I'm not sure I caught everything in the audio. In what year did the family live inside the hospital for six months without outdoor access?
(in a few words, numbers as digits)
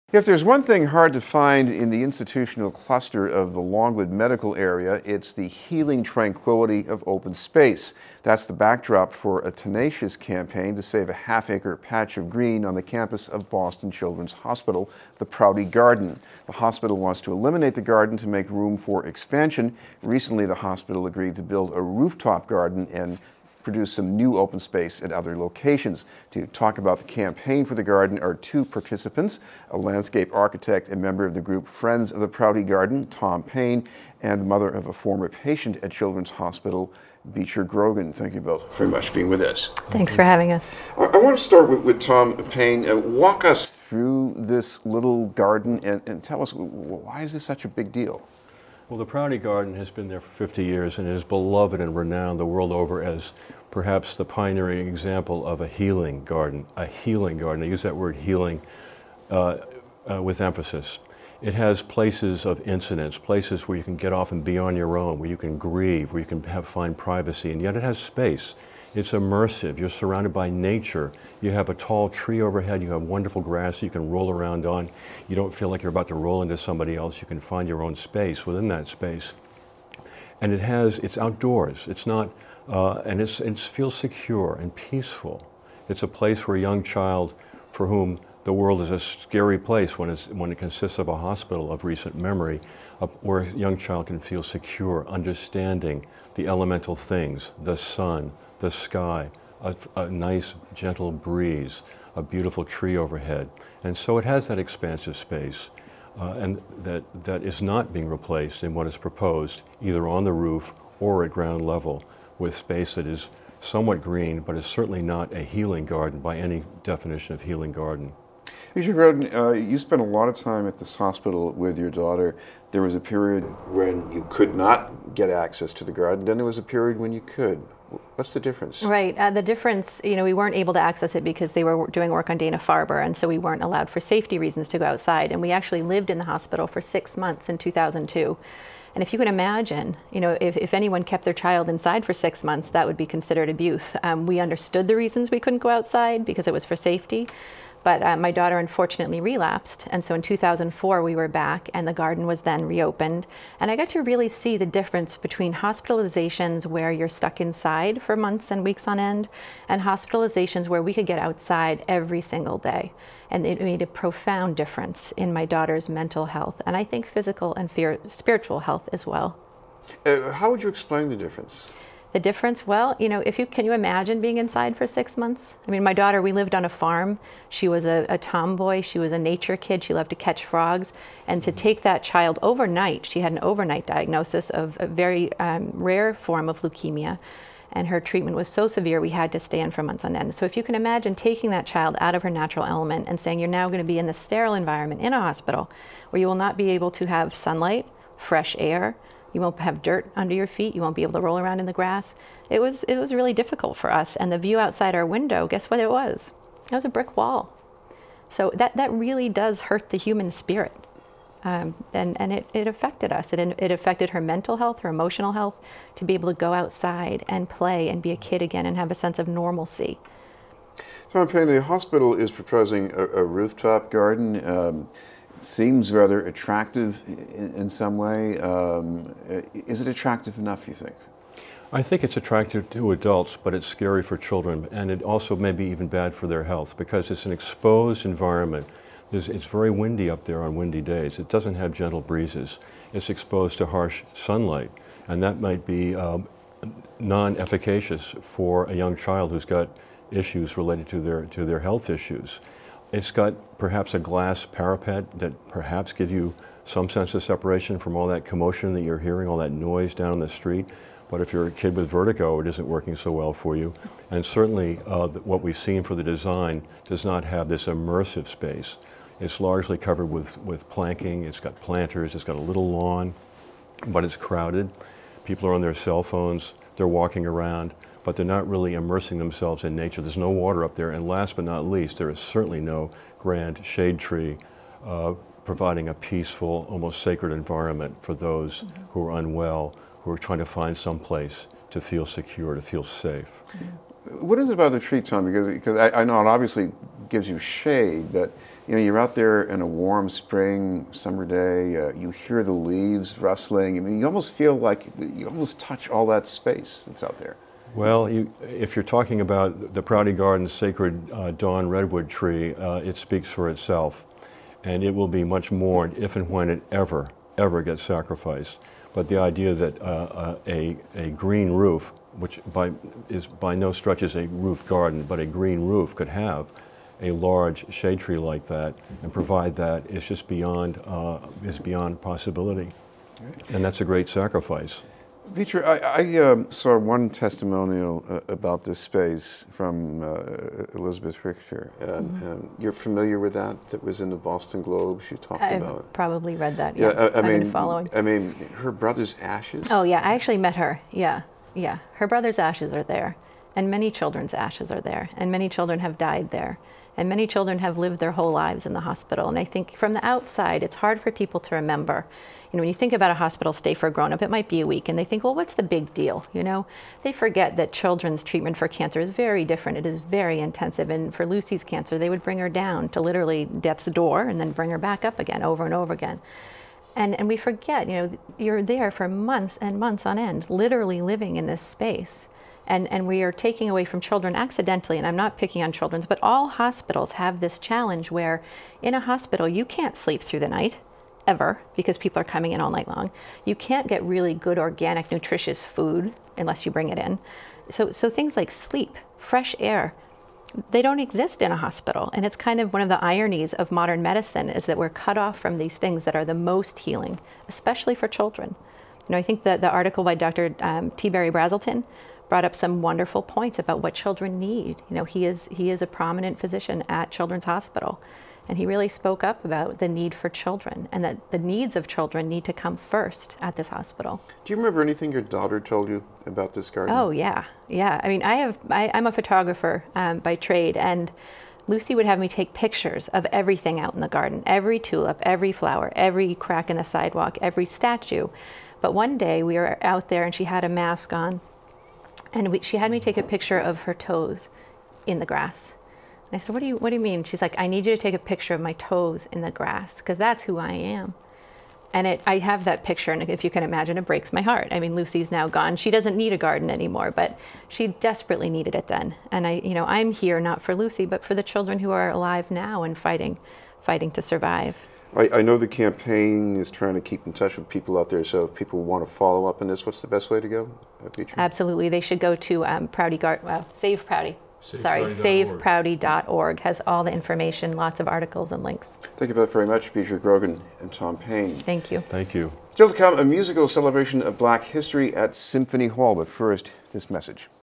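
2002.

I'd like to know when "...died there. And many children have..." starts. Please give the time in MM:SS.
05:55.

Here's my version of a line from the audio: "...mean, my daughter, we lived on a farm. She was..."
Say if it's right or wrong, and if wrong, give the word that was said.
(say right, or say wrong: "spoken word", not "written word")
right.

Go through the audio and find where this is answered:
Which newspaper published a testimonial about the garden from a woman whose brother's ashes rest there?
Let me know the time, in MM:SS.
05:44.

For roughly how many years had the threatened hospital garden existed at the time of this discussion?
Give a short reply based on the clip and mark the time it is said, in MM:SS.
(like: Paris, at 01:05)
50 years, at 00:50.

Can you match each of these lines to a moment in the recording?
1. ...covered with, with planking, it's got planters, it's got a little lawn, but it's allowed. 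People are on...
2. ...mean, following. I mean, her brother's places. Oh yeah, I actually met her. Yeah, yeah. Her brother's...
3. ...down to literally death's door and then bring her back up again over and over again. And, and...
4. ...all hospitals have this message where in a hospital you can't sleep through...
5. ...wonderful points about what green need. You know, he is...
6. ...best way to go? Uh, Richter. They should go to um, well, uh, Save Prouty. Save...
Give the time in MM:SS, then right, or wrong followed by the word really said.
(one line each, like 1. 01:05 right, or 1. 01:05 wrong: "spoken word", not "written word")
1. 04:29 wrong: "crowded", not "allowed"
2. 05:47 wrong: "ashes", not "places"
3. 06:12 right
4. 06:26 wrong: "challenge", not "message"
5. 06:52 wrong: "children", not "green"
6. 07:50 wrong: "Absolutely", not "Richter".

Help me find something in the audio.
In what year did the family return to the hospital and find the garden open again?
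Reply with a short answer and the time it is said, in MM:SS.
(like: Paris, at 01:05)
2004, at 02:30.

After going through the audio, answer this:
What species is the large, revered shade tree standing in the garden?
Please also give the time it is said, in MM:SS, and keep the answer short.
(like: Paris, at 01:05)
dawn redwood, at 05:11.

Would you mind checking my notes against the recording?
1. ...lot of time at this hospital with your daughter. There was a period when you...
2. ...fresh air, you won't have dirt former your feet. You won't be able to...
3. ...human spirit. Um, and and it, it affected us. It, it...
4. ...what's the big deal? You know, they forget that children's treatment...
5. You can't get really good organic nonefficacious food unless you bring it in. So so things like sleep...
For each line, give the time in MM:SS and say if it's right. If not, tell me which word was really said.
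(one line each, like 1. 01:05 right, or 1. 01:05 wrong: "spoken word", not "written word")
1. 02:00 right
2. 03:18 wrong: "under", not "former"
3. 03:29 right
4. 06:05 right
5. 06:33 wrong: "nutritious", not "nonefficacious".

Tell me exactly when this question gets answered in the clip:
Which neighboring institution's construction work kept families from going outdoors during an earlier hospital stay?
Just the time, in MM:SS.
02:12.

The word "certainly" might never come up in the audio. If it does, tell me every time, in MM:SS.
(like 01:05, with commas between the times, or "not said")
01:54, 04:24, 04:42.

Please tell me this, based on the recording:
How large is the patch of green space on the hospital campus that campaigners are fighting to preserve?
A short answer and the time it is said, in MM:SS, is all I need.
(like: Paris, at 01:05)
half acre, at 00:11.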